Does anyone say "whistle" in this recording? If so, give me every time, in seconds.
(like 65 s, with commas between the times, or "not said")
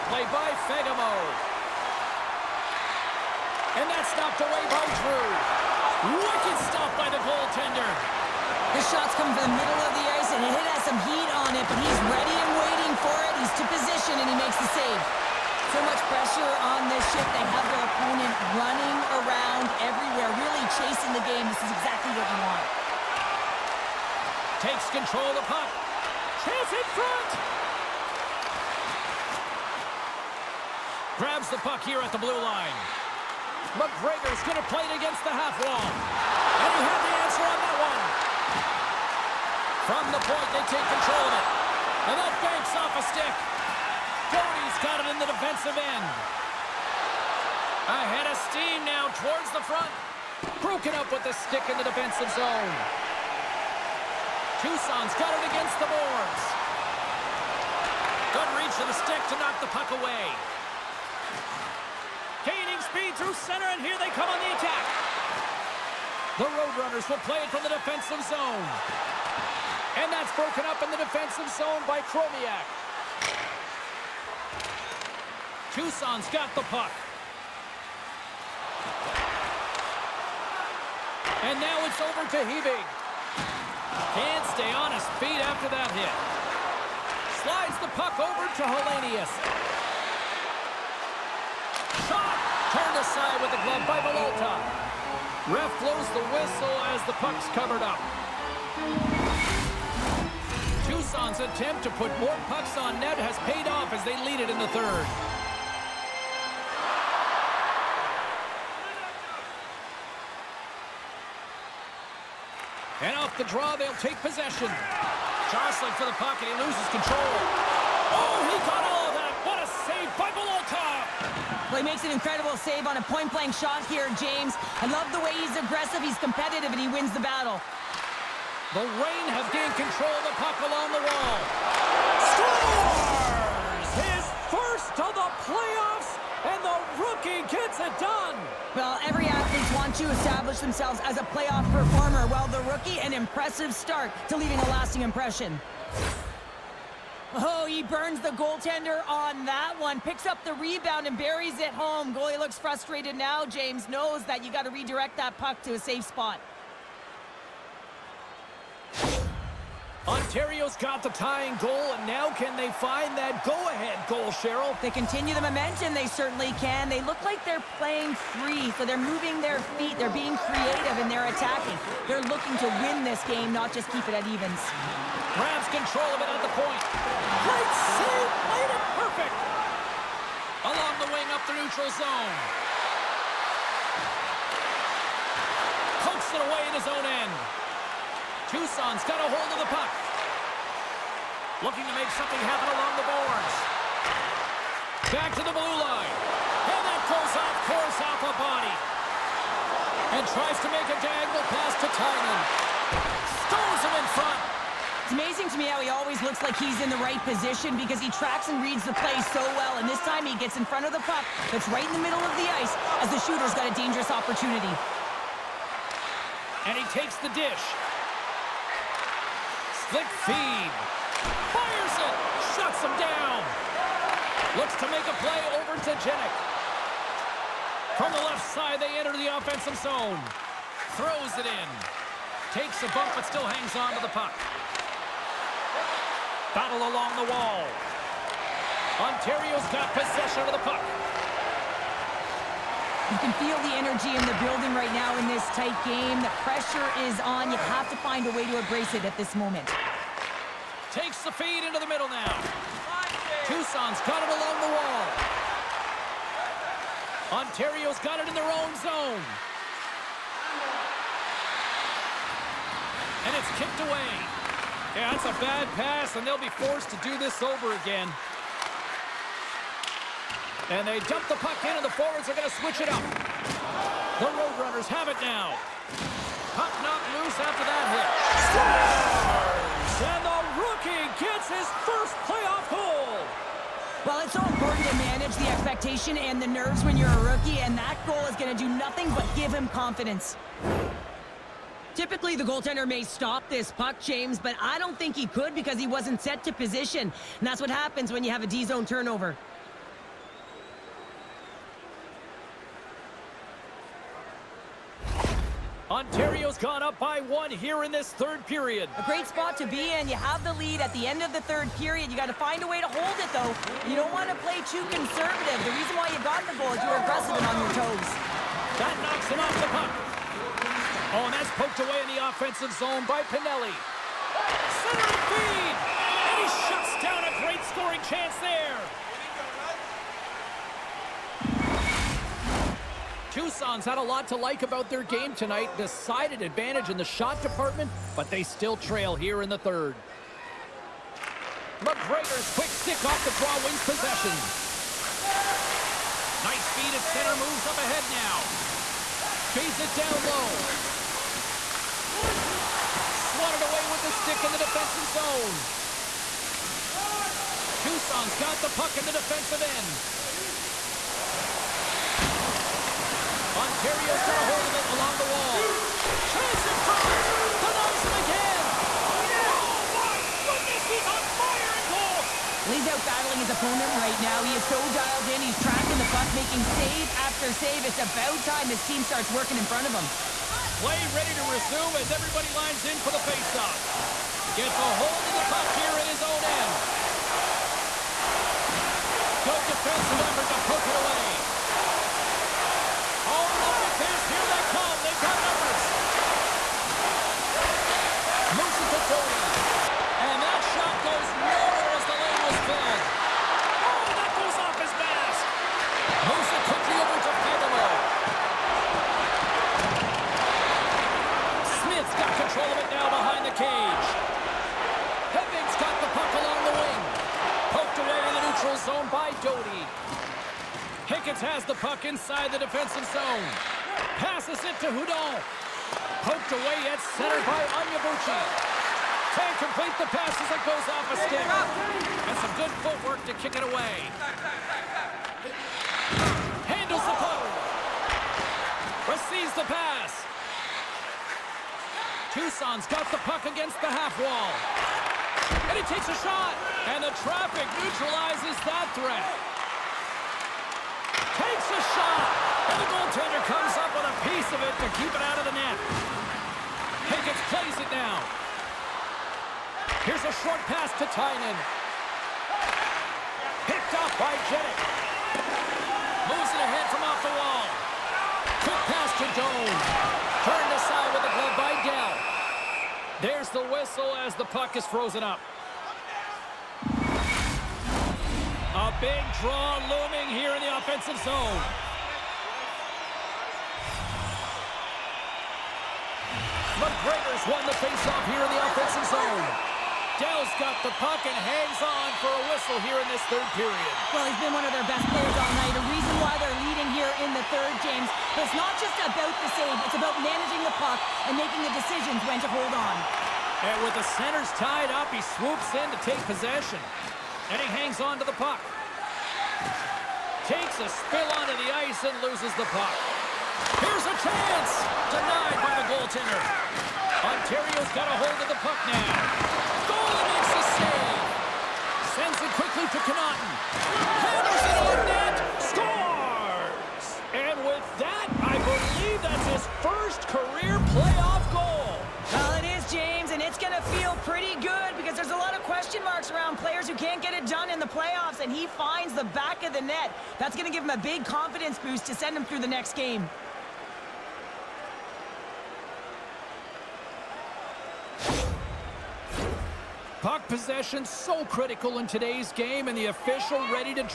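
96 s, 473 s, 492 s.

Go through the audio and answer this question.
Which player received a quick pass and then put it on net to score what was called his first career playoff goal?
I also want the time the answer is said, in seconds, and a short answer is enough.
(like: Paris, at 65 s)
Connaughton, at 523 s.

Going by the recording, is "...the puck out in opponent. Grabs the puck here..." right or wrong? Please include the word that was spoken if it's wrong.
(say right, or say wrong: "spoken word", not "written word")
wrong: "front", not "opponent".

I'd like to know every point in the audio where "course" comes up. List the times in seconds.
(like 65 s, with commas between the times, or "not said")
197 s.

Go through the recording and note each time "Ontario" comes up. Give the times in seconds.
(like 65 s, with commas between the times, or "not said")
160 s, 238 s, 257 s, 517 s.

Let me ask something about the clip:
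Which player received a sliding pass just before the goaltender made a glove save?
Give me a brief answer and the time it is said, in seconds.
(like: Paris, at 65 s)
Helenius, at 88 s.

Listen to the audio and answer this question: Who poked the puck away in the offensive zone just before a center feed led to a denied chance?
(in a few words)
Pinelli.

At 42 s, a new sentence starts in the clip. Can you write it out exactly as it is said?
And that banks off a stick.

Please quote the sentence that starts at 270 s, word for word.
And they dump the puck in, and the forwards are going to switch it up.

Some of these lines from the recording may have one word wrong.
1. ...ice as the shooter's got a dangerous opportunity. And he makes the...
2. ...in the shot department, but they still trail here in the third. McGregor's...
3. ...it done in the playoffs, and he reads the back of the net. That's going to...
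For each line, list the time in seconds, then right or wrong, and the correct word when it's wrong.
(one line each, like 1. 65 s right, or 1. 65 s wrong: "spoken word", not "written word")
1. 212 s wrong: "takes", not "makes"
2. 336 s right
3. 537 s wrong: "finds", not "reads".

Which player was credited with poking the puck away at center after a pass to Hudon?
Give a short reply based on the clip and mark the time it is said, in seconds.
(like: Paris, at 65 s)
Onyebuchi, at 427 s.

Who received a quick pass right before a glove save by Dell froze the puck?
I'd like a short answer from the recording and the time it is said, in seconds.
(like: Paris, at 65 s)
Doan, at 469 s.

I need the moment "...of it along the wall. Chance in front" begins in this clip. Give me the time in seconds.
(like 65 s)
364 s.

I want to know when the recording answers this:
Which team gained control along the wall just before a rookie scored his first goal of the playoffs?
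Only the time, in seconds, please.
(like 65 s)
128 s.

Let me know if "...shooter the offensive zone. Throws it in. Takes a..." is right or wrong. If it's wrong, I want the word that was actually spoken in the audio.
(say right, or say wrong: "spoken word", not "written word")
wrong: "enter", not "shooter".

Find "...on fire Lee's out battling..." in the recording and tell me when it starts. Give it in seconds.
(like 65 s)
371 s.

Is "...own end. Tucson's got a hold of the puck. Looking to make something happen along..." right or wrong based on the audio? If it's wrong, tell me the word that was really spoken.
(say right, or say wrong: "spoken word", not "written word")
right.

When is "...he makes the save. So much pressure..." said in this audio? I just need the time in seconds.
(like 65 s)
14 s.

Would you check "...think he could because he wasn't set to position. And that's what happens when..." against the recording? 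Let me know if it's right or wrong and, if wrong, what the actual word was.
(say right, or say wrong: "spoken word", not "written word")
right.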